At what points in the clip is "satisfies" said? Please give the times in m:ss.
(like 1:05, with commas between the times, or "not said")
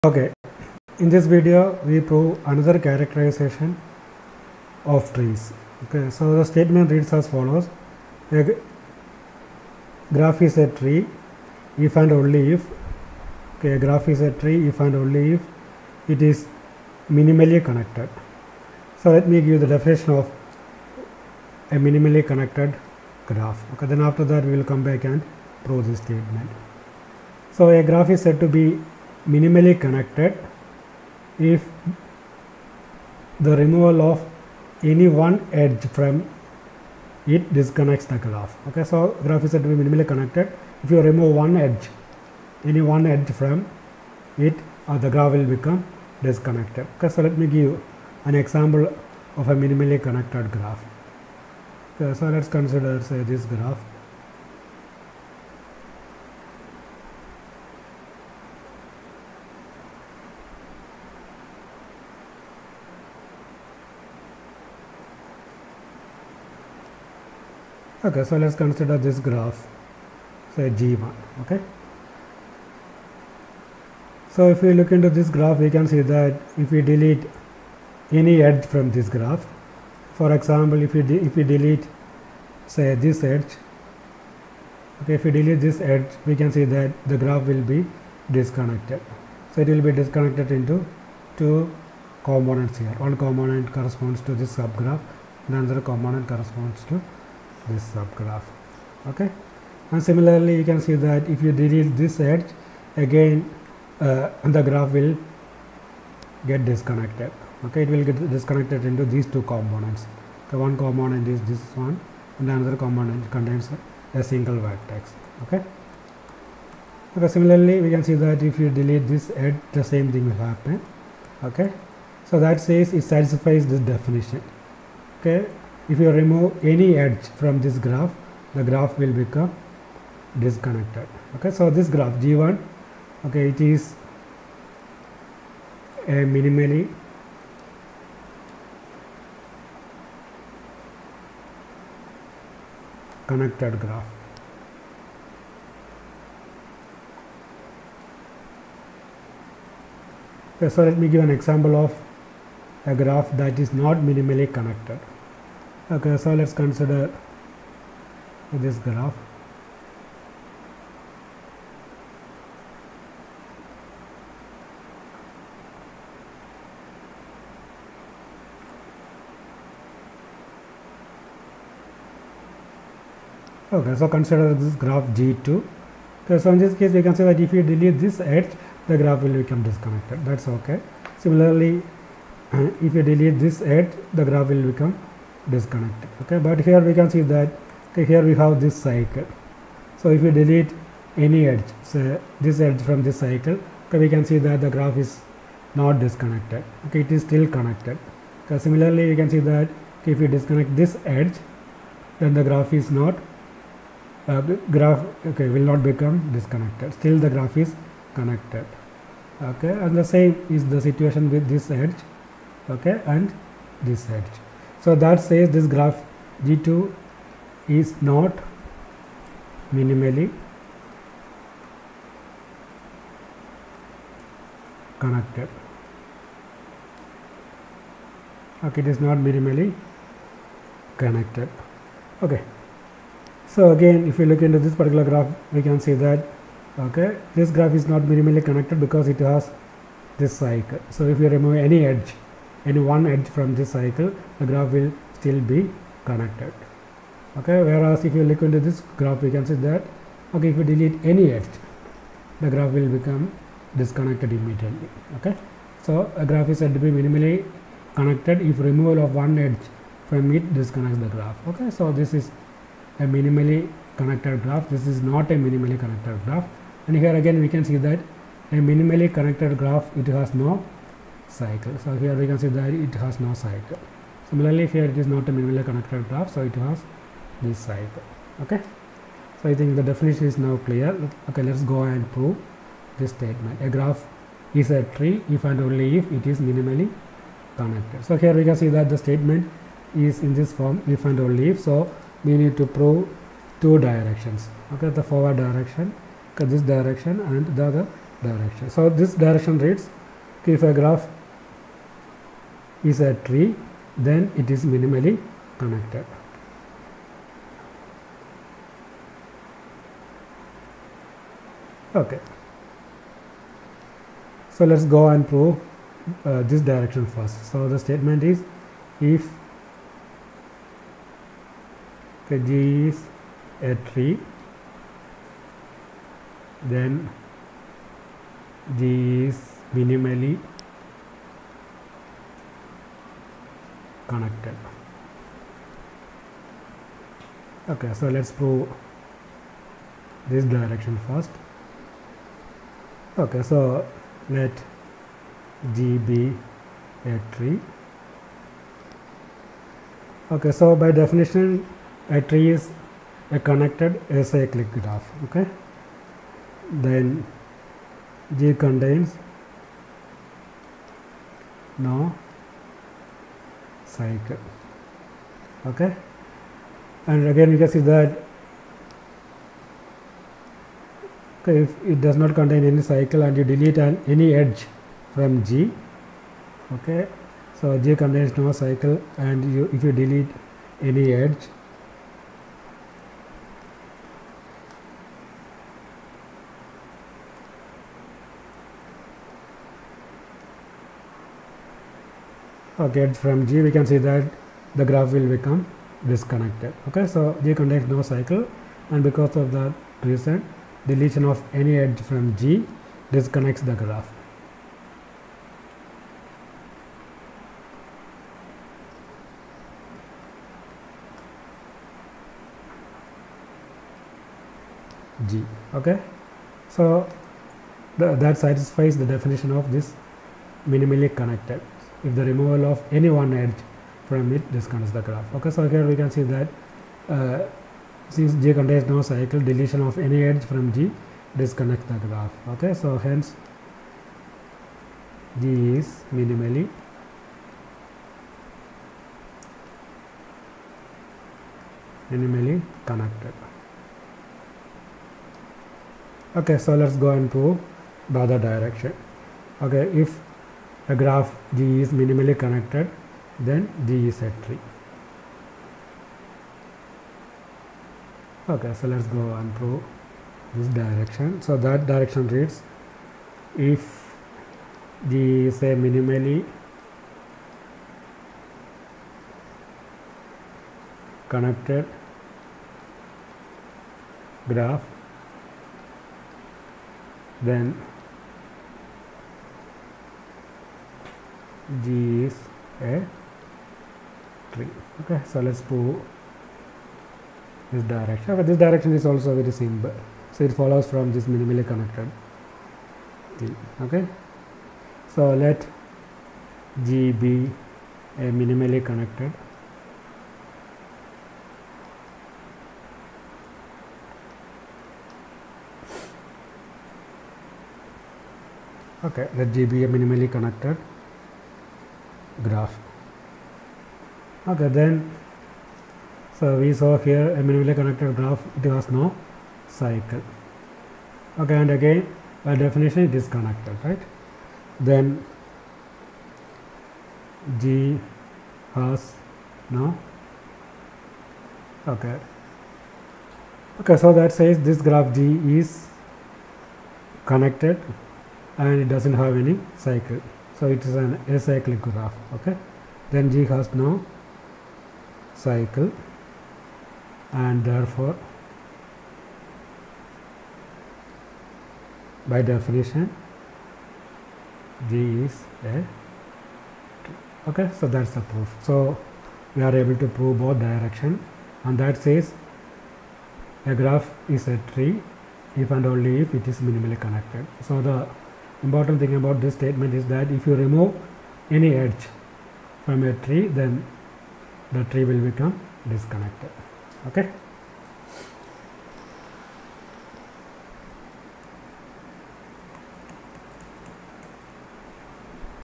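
2:03, 6:58.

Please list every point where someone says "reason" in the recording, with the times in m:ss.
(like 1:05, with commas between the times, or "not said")
6:40.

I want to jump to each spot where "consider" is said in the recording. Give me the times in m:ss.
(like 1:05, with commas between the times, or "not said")
0:52, 1:08, 2:36, 2:54.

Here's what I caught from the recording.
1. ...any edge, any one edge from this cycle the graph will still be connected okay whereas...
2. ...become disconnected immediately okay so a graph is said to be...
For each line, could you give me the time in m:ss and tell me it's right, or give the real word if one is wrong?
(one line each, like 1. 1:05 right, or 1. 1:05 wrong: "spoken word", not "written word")
1. 4:01 right
2. 4:12 right.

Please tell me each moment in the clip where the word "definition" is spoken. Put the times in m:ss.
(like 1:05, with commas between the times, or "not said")
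0:19, 2:03, 4:39, 5:51, 6:59, 8:42, 9:12.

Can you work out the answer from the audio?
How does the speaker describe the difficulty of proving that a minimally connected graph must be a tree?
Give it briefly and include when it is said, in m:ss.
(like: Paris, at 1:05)
Very simple, at 8:09.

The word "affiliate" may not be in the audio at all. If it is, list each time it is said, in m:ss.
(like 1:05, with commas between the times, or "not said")
not said.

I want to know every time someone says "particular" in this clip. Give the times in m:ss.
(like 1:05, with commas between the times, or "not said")
3:54.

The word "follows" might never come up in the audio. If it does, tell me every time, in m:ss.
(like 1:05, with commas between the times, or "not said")
0:07, 8:10.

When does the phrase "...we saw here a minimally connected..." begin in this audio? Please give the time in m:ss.
8:36.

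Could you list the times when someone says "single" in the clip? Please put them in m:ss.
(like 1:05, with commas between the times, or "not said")
1:54.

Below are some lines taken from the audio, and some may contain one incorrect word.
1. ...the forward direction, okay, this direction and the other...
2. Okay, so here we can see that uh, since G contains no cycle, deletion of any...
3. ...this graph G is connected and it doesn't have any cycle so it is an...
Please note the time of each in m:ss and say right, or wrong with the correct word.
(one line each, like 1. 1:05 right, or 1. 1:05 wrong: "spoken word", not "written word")
1. 4:54 right
2. 7:05 right
3. 8:54 right.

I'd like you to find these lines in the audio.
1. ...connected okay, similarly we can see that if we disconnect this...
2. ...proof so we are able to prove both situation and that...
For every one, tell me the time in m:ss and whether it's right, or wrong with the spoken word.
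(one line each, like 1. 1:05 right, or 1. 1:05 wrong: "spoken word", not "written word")
1. 3:17 right
2. 9:18 wrong: "direction", not "situation".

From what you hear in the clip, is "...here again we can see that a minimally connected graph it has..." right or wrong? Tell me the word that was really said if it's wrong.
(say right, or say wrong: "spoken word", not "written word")
right.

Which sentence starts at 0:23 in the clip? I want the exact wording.
Okay, then after that we will come back and prove this statement.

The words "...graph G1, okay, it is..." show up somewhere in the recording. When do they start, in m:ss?
2:11.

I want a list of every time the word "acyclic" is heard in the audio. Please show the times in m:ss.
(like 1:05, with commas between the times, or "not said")
5:54, 9:01.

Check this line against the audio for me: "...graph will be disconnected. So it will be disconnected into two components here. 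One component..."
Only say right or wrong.
right.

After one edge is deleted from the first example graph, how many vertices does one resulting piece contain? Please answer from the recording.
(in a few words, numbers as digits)
1.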